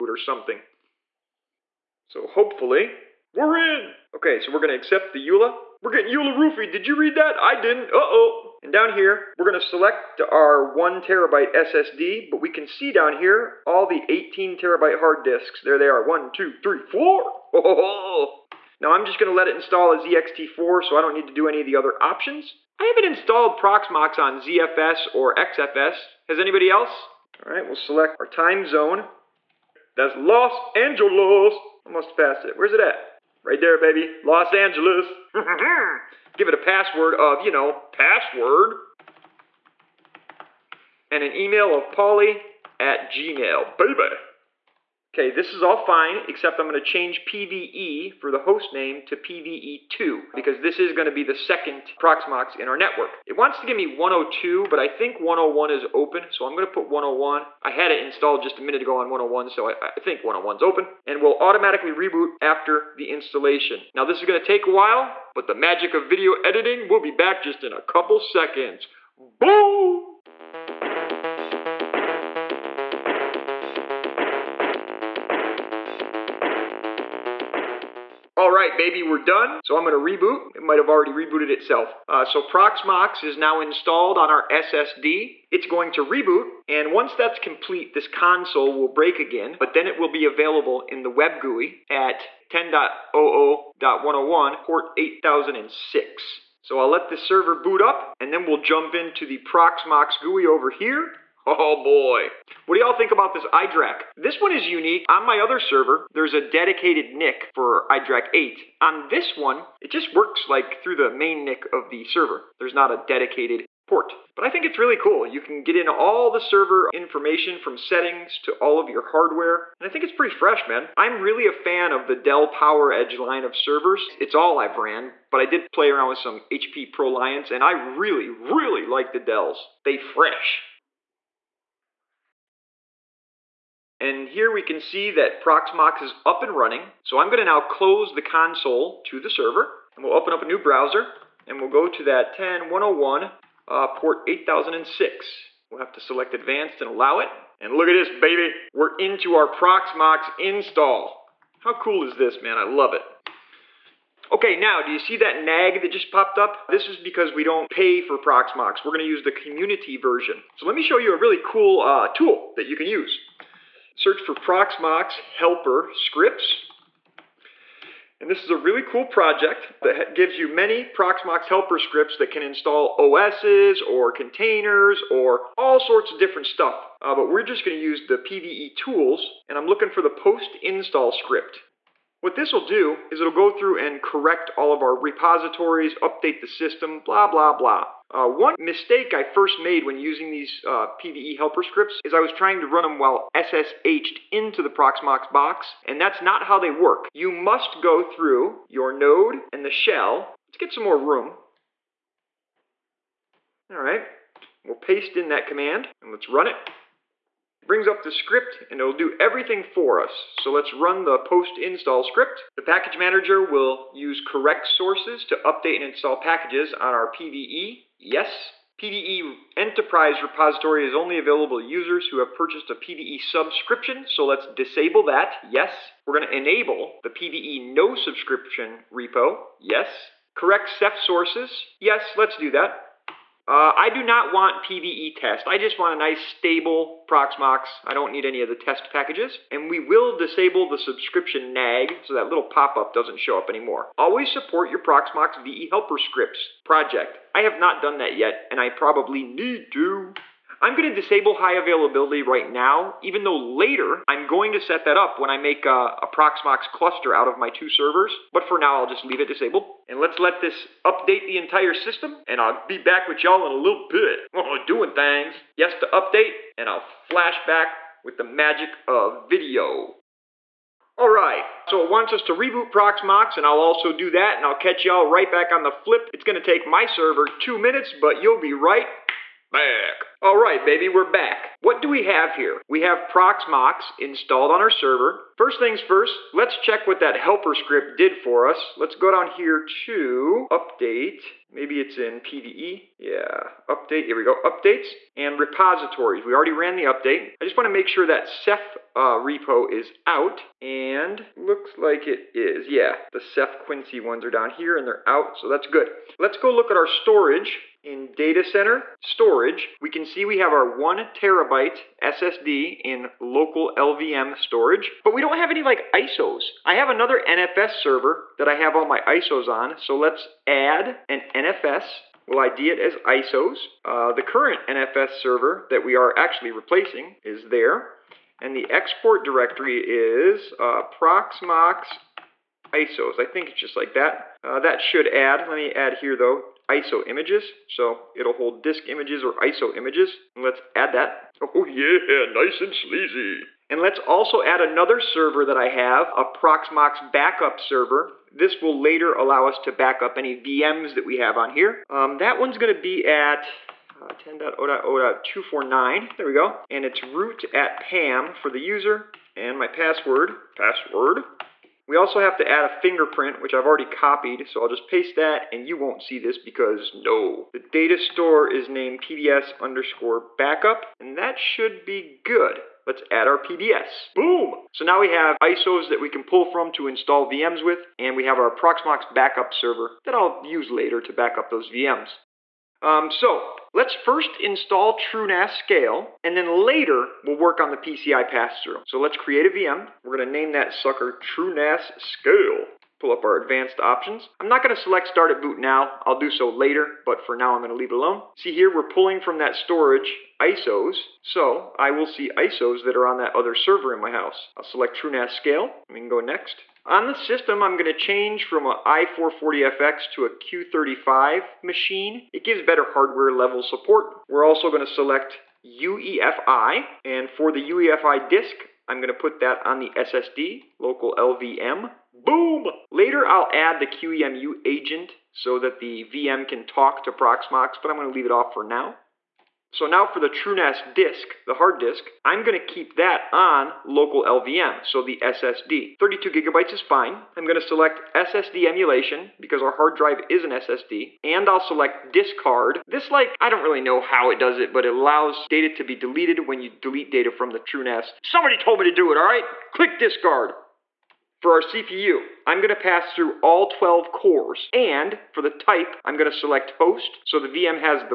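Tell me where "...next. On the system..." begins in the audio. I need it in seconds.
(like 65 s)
406 s.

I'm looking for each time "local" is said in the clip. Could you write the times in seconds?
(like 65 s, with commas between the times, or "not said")
313 s, 420 s, 433 s.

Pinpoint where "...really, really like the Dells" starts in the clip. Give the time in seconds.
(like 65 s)
127 s.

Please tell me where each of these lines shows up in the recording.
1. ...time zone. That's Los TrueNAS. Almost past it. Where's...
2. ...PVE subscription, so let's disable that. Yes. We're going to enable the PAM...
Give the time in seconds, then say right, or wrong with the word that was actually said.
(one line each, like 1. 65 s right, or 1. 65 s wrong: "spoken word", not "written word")
1. 28 s wrong: "Angeles", not "TrueNAS"
2. 222 s wrong: "PVE", not "PAM".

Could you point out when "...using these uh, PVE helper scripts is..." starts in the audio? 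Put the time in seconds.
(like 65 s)
189 s.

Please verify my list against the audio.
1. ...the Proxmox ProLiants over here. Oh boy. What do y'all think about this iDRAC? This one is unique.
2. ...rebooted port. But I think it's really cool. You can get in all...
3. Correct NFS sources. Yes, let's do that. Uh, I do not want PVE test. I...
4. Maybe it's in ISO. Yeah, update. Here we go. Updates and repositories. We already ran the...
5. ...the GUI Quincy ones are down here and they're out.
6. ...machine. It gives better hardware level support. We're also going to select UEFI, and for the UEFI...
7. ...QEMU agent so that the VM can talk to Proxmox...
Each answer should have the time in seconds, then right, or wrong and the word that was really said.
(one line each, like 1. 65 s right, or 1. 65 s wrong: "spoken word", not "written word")
1. 99 s wrong: "GUI", not "ProLiants"
2. 113 s wrong: "dedicated", not "rebooted"
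3. 230 s wrong: "Ceph", not "NFS"
4. 291 s wrong: "PVE", not "ISO"
5. 303 s wrong: "Ceph", not "GUI"
6. 411 s right
7. 423 s right.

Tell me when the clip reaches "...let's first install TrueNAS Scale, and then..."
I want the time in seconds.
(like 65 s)
383 s.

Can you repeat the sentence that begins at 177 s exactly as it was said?
Uh, but we're just going to use the PVE tools, and I'm looking for the post install script.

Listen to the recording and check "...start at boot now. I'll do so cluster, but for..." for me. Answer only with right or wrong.
wrong.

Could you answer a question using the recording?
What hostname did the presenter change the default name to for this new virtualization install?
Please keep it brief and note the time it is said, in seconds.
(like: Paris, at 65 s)
PVE2, at 49 s.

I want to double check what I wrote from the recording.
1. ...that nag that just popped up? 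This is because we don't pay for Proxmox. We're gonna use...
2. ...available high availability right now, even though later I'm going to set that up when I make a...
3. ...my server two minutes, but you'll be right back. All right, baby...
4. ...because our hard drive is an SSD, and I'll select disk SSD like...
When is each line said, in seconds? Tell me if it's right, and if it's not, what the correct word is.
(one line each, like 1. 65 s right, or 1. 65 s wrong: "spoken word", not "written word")
1. 155 s right
2. 250 s wrong: "disable", not "available"
3. 276 s right
4. 439 s wrong: "This", not "SSD".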